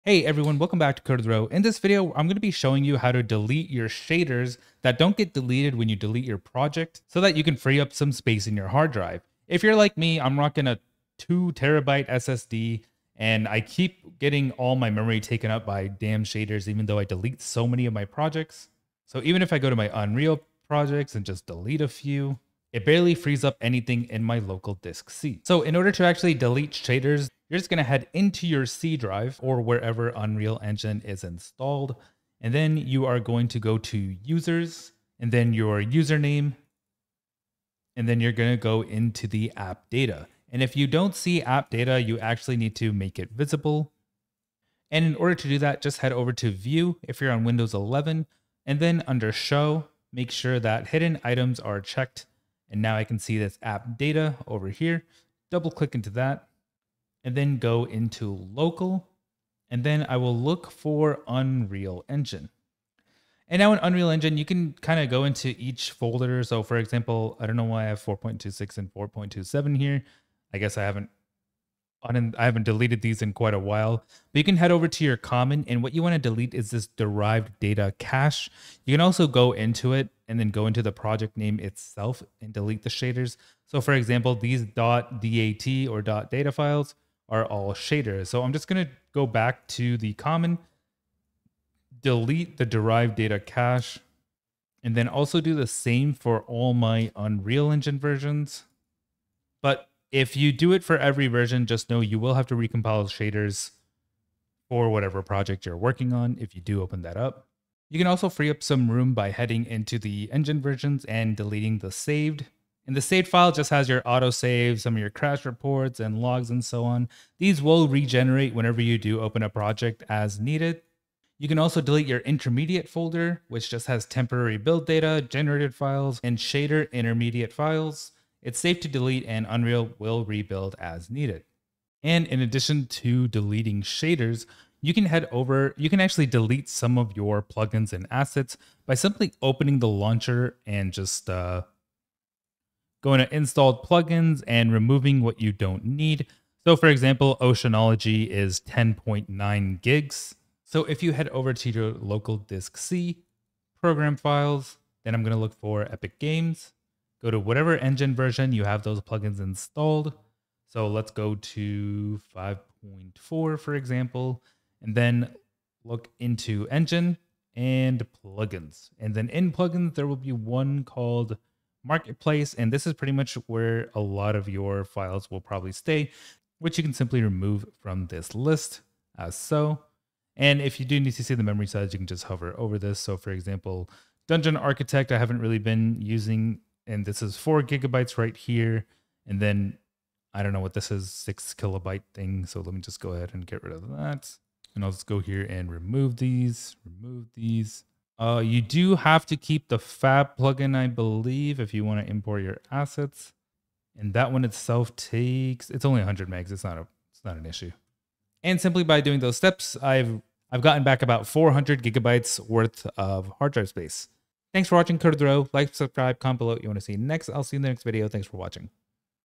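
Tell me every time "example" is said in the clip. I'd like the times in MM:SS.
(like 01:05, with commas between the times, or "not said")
01:06, 01:23, 02:26, 02:43, 03:03.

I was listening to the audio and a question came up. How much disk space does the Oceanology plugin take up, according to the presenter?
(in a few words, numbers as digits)
10.9 gigs.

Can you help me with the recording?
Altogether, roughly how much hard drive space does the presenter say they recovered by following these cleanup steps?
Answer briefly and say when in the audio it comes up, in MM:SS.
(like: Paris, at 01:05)
400 gigabytes, at 03:31.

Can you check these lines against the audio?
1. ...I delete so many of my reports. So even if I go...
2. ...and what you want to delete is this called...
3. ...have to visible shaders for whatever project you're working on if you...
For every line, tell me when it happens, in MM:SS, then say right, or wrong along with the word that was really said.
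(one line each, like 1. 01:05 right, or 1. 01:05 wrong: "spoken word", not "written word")
1. 00:16 wrong: "projects", not "reports"
2. 01:15 wrong: "derived", not "called"
3. 01:42 wrong: "recompile", not "visible".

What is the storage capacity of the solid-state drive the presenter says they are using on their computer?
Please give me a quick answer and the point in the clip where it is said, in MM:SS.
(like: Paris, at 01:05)
2 terabytes, at 00:11.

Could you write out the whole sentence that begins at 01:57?
These will regenerate whenever you do open a project as needed.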